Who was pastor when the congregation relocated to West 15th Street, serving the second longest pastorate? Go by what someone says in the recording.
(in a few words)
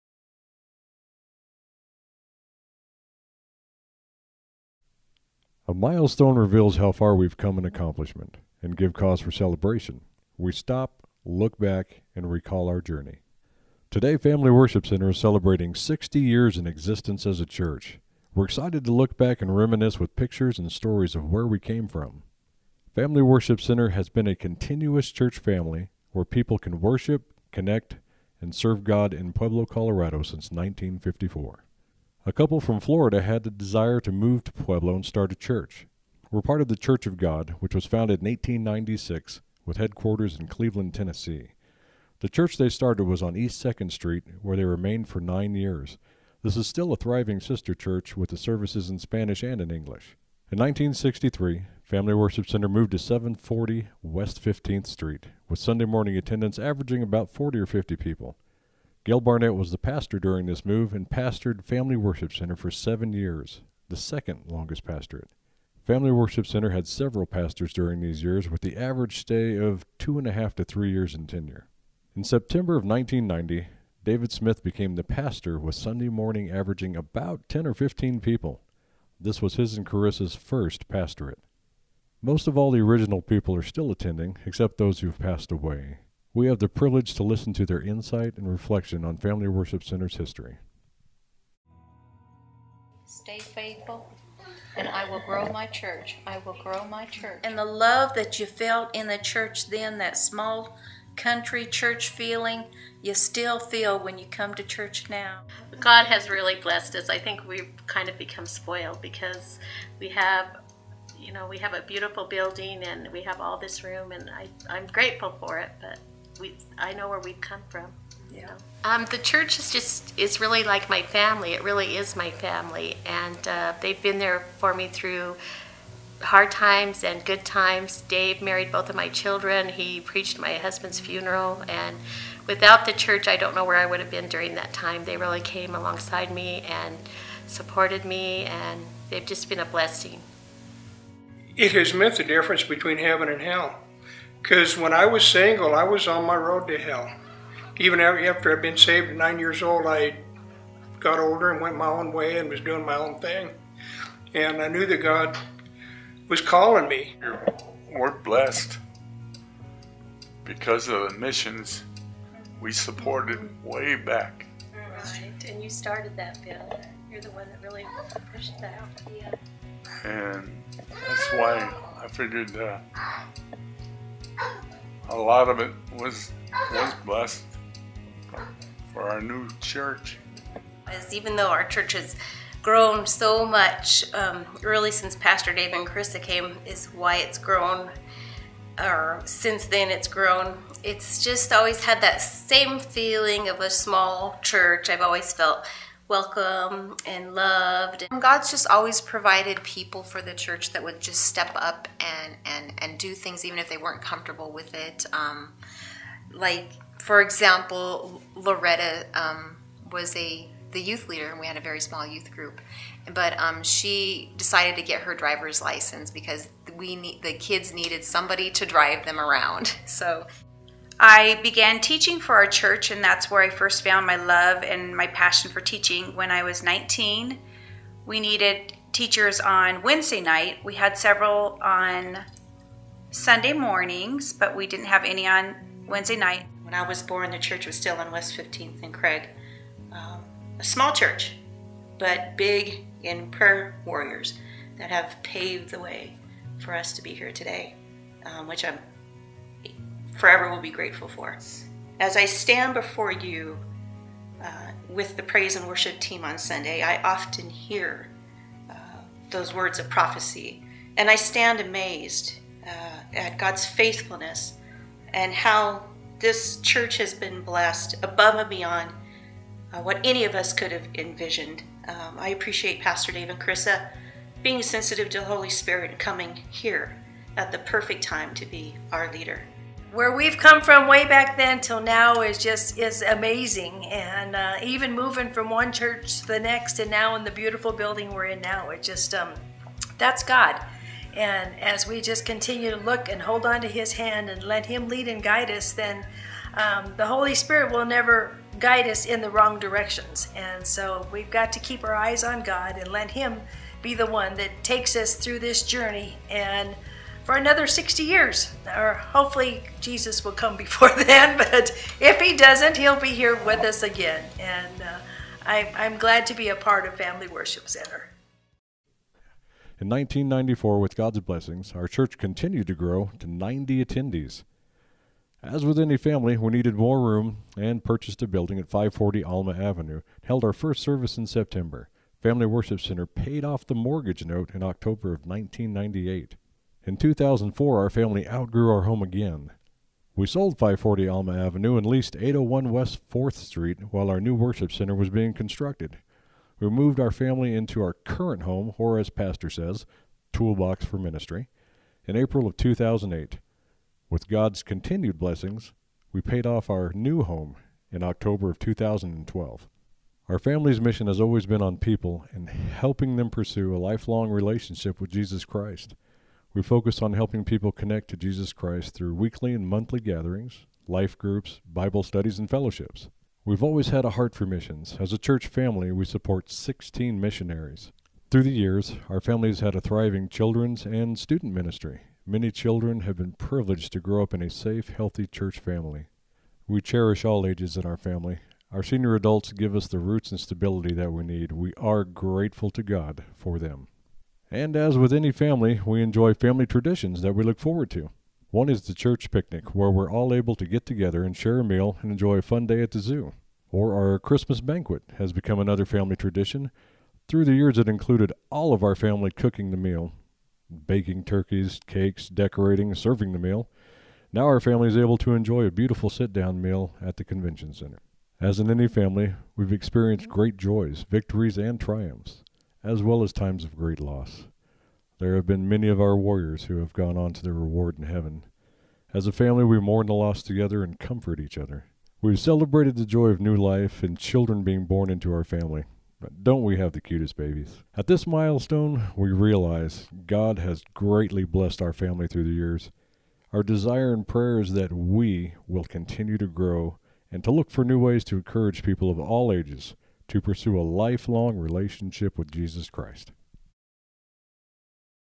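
Gail Barnett.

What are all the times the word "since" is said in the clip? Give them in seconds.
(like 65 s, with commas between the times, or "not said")
30 s, 184 s, 189 s.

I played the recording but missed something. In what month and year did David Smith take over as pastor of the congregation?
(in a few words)
September 1990.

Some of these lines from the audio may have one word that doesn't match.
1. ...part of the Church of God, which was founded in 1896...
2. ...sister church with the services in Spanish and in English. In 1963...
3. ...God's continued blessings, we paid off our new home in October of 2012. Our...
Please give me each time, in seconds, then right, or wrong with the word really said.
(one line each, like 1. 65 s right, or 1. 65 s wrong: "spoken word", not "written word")
1. 36 s right
2. 47 s right
3. 354 s right.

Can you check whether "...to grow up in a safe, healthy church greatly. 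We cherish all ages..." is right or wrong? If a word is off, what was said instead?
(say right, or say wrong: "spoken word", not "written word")
wrong: "family", not "greatly".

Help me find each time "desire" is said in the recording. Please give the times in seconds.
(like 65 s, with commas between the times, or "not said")
33 s, 443 s.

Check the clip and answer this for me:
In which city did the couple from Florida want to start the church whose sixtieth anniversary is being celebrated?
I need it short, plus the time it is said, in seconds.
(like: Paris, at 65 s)
Pueblo, Colorado, at 29 s.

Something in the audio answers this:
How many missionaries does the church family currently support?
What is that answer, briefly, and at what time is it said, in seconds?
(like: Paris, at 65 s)
16, at 376 s.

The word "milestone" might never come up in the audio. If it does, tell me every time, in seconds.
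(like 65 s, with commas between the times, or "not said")
5 s, 438 s.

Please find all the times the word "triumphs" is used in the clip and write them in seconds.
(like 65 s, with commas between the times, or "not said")
421 s.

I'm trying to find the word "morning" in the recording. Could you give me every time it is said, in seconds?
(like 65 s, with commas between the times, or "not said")
55 s, 76 s, 233 s.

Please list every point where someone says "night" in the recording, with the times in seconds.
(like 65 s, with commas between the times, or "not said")
230 s, 236 s.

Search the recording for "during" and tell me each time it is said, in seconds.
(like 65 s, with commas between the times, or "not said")
60 s, 67 s, 134 s.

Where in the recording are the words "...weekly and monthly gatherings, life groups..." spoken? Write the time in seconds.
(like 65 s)
369 s.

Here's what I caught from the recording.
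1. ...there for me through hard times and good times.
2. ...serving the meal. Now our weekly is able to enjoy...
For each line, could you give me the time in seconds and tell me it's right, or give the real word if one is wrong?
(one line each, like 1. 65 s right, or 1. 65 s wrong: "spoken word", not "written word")
1. 124 s right
2. 412 s wrong: "family", not "weekly".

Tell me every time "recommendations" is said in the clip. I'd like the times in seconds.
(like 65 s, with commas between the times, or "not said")
not said.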